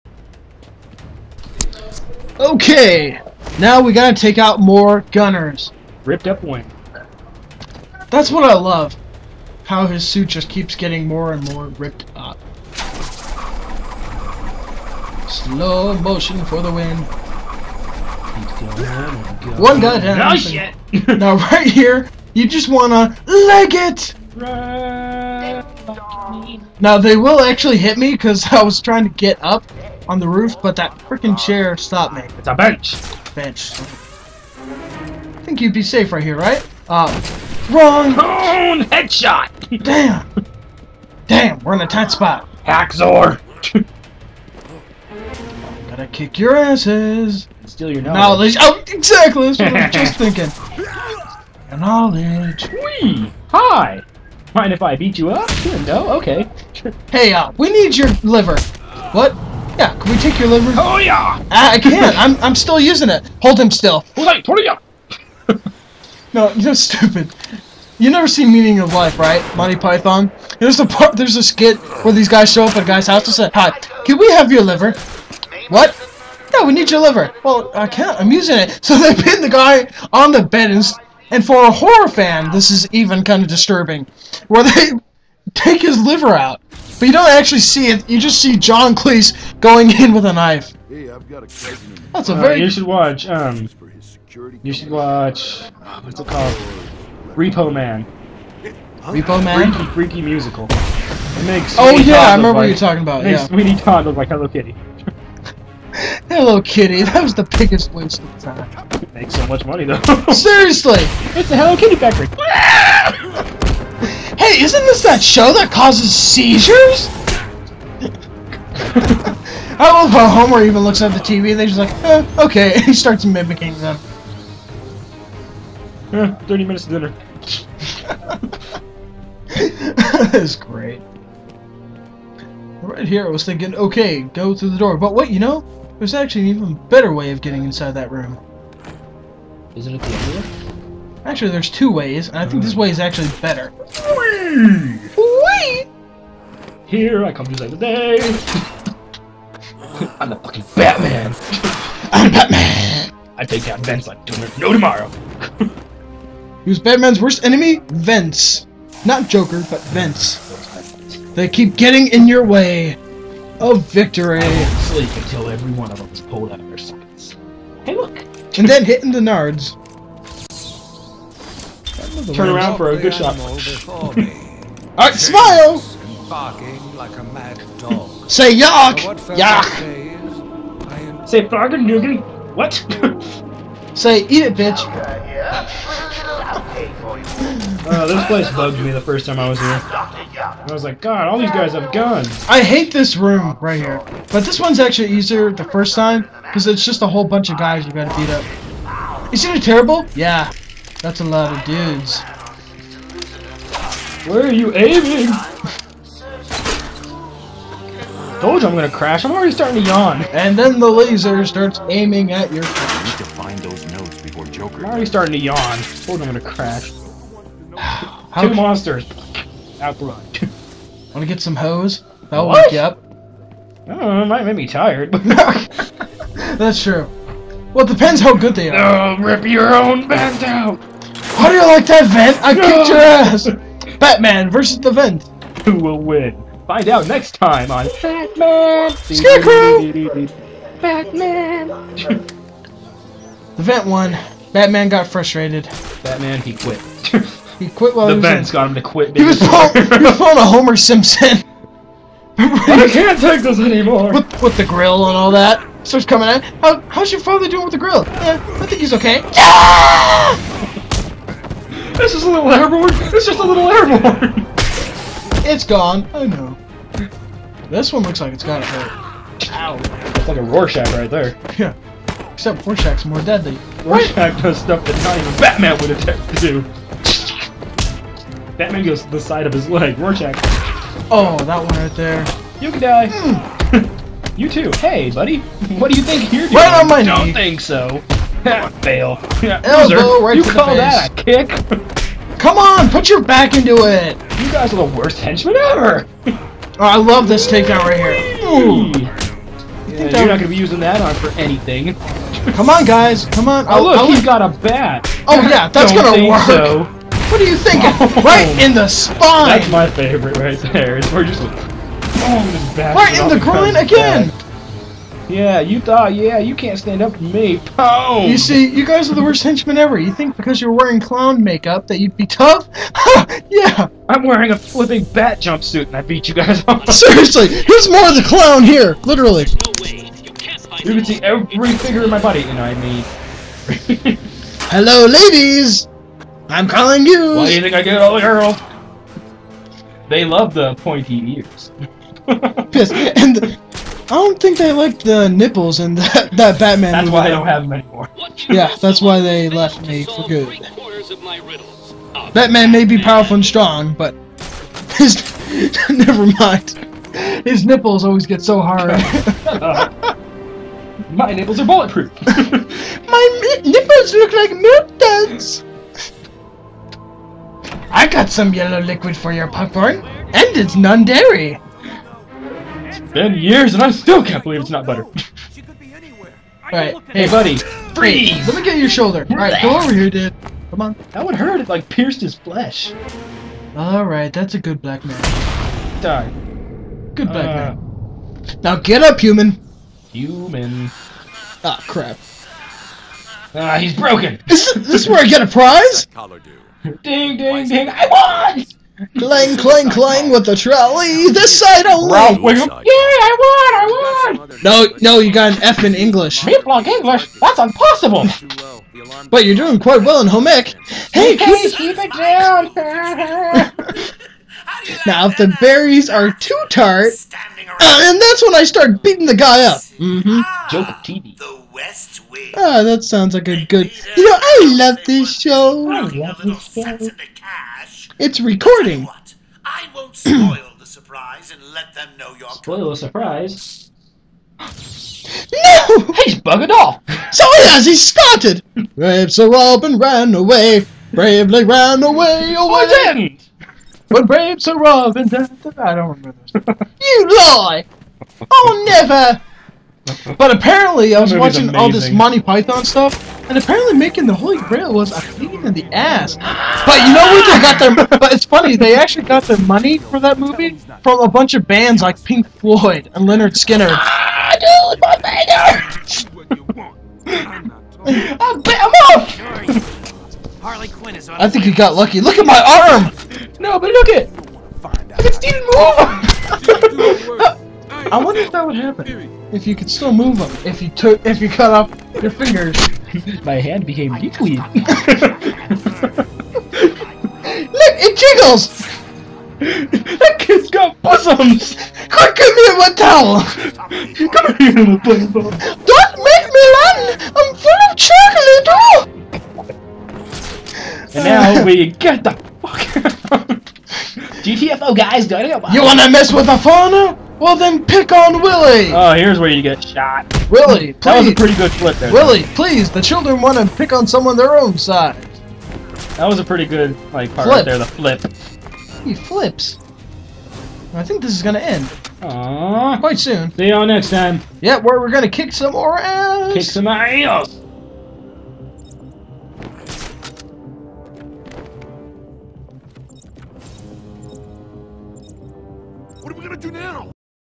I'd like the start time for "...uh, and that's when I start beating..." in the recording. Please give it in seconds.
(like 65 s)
417 s.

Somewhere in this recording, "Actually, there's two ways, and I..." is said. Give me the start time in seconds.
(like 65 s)
141 s.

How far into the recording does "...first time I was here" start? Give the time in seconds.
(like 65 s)
189 s.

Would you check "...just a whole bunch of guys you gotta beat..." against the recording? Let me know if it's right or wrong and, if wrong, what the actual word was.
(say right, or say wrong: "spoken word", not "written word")
right.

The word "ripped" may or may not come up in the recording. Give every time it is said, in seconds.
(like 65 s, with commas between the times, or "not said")
6 s, 11 s.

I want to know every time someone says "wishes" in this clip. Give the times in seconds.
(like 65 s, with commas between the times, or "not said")
not said.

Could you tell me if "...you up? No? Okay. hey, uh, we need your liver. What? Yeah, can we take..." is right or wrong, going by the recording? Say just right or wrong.
right.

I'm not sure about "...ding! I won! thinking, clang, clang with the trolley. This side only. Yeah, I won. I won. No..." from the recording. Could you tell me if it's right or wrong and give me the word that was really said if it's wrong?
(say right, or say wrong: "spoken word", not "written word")
wrong: "clang", not "thinking".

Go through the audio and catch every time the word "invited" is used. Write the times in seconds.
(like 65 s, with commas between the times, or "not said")
not said.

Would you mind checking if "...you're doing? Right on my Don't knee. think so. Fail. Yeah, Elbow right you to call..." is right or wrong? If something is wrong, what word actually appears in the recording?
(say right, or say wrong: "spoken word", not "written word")
right.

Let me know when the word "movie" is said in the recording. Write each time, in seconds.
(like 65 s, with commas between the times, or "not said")
347 s, 460 s.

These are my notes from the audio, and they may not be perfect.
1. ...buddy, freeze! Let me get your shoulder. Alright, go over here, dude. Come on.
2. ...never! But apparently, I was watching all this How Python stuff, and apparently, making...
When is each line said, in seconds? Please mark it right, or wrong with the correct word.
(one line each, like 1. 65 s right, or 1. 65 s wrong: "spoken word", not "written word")
1. 377 s right
2. 448 s wrong: "Monty", not "How".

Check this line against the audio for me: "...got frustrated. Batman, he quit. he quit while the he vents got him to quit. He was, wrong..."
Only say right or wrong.
wrong.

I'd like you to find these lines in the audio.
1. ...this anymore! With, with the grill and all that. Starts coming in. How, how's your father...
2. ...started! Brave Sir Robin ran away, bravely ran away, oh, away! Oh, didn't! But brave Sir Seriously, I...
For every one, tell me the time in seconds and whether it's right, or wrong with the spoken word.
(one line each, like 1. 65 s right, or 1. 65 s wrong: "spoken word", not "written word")
1. 253 s right
2. 437 s wrong: "Robin", not "Seriously".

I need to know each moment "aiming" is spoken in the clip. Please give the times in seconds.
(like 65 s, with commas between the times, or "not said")
204 s, 211 s.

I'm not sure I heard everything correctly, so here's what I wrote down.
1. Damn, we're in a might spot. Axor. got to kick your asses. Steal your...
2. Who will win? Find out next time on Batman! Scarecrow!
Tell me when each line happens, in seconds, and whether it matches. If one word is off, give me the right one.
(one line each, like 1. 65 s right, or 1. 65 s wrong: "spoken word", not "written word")
1. 41 s wrong: "tight", not "might"
2. 235 s right.